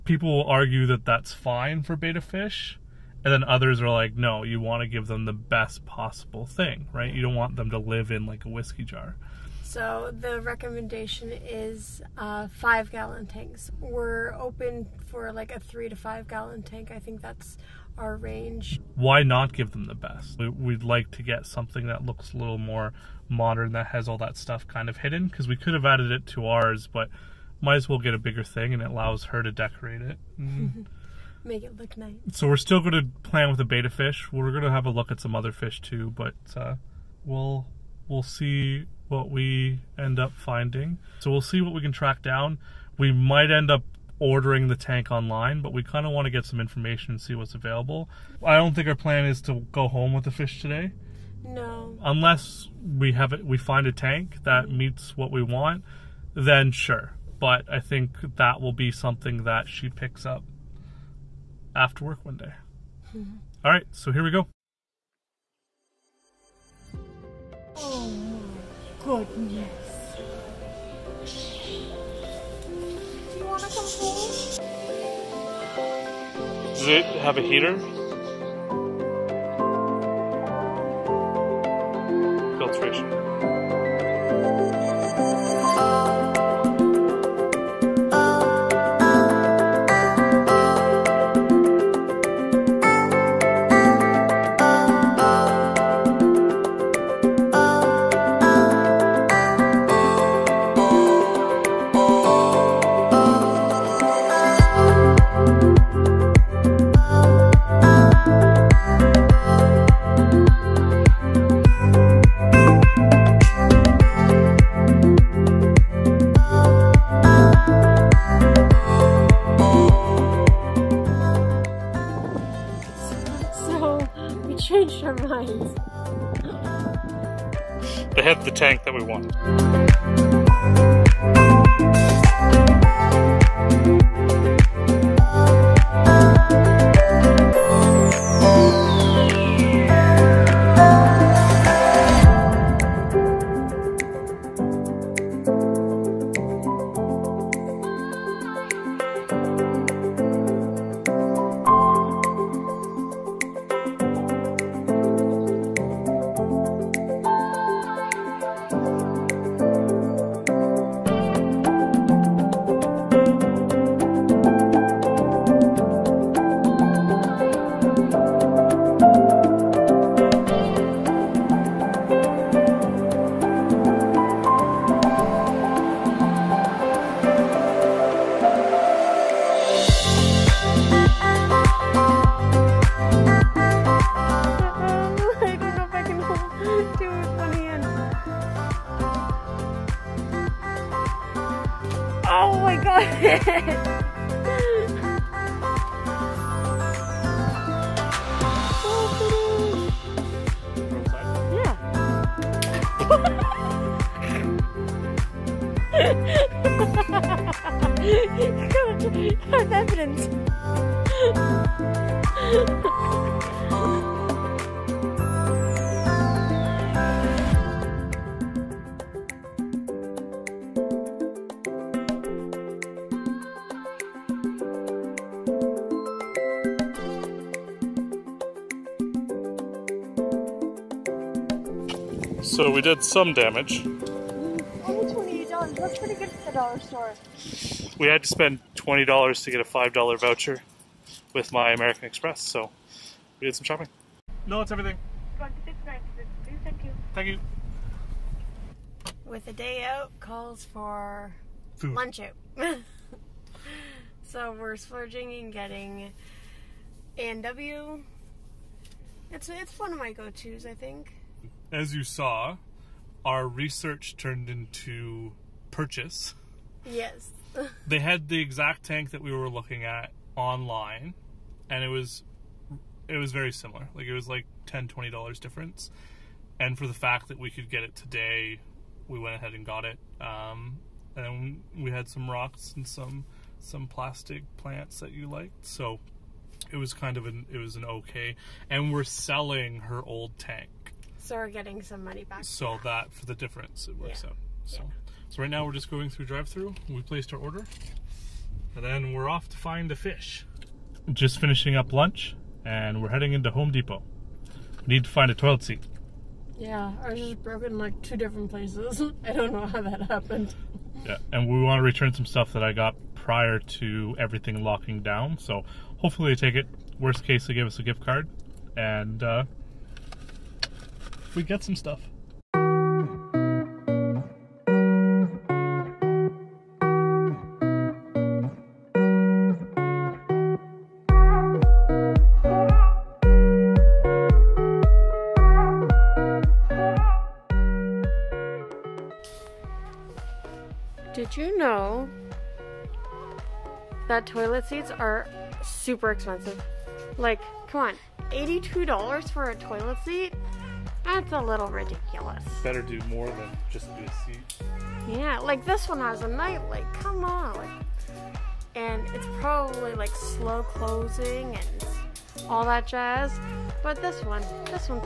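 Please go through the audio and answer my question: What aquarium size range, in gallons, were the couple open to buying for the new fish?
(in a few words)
3 to 5 gallons.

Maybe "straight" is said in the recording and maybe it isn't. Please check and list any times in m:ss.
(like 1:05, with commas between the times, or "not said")
not said.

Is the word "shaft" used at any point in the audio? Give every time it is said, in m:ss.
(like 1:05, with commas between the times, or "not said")
not said.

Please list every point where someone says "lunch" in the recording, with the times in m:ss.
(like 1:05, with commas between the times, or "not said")
4:11, 5:01.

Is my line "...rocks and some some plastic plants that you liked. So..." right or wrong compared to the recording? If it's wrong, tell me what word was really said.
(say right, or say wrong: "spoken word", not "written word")
right.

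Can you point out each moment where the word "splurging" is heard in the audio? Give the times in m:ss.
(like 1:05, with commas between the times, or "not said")
4:14.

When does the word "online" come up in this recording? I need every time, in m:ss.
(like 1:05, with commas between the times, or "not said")
0:45, 4:30.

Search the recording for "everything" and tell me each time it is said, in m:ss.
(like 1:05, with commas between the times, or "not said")
4:04, 5:14.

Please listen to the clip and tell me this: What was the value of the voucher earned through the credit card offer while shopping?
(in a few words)
$5.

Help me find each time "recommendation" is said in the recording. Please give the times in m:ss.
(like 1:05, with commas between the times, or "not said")
0:10.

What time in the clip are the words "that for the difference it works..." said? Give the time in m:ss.
4:52.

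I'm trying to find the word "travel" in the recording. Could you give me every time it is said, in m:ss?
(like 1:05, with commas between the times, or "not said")
not said.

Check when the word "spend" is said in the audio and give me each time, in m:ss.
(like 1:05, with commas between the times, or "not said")
3:58.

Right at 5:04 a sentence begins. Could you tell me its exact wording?
We need to find a toilet seat.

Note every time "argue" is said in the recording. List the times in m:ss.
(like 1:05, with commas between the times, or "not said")
0:00.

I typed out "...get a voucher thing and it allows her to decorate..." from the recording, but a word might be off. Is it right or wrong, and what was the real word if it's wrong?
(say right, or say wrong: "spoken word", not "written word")
wrong: "bigger", not "voucher".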